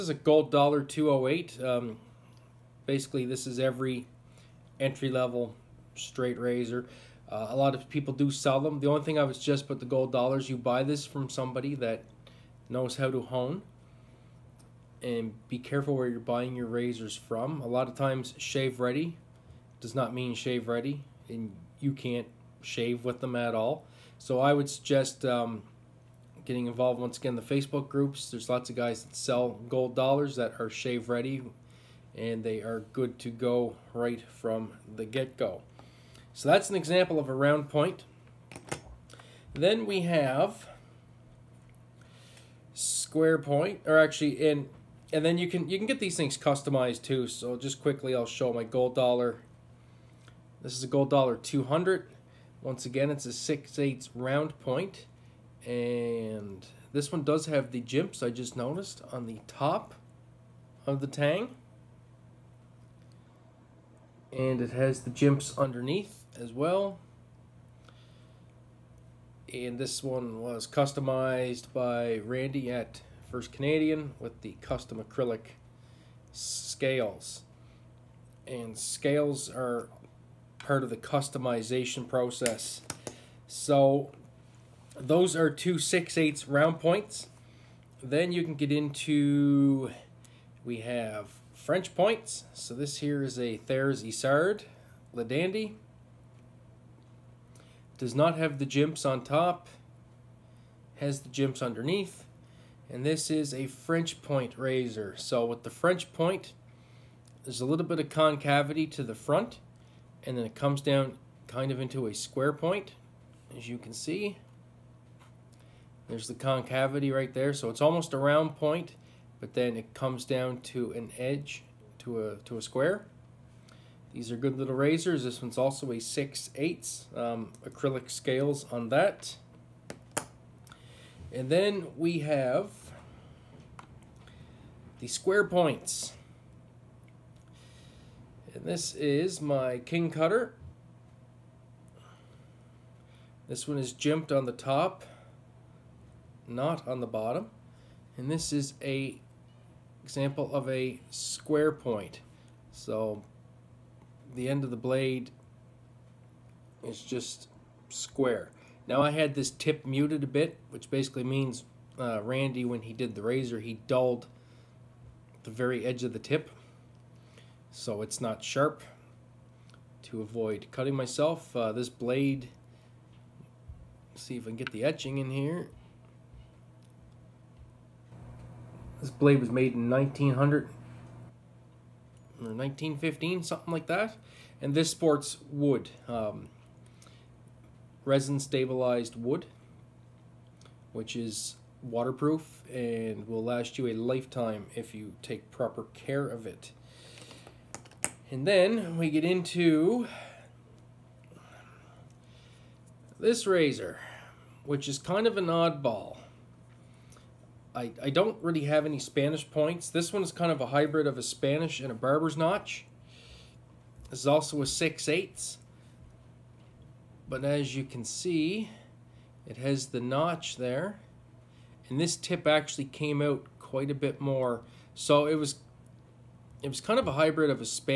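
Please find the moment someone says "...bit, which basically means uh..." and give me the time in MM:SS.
02:40.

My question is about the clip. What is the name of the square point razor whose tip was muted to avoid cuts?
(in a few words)
King Cutter.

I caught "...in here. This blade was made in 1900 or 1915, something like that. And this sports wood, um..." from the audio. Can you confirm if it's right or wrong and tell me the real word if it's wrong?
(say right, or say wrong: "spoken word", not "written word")
right.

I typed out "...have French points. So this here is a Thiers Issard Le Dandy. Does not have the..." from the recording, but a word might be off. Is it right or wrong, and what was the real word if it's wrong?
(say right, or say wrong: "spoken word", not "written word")
right.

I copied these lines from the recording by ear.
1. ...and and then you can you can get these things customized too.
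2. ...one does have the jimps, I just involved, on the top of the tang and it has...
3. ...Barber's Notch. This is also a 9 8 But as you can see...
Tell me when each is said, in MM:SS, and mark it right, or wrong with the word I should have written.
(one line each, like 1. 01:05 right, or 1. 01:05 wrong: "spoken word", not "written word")
1. 00:44 right
2. 00:57 wrong: "noticed", not "involved"
3. 03:31 wrong: "6", not "9".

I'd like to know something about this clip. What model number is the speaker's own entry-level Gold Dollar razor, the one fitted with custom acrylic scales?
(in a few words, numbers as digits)
200.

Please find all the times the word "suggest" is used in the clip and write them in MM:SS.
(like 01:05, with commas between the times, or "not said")
00:09, 00:24.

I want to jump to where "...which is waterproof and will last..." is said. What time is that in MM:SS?
03:10.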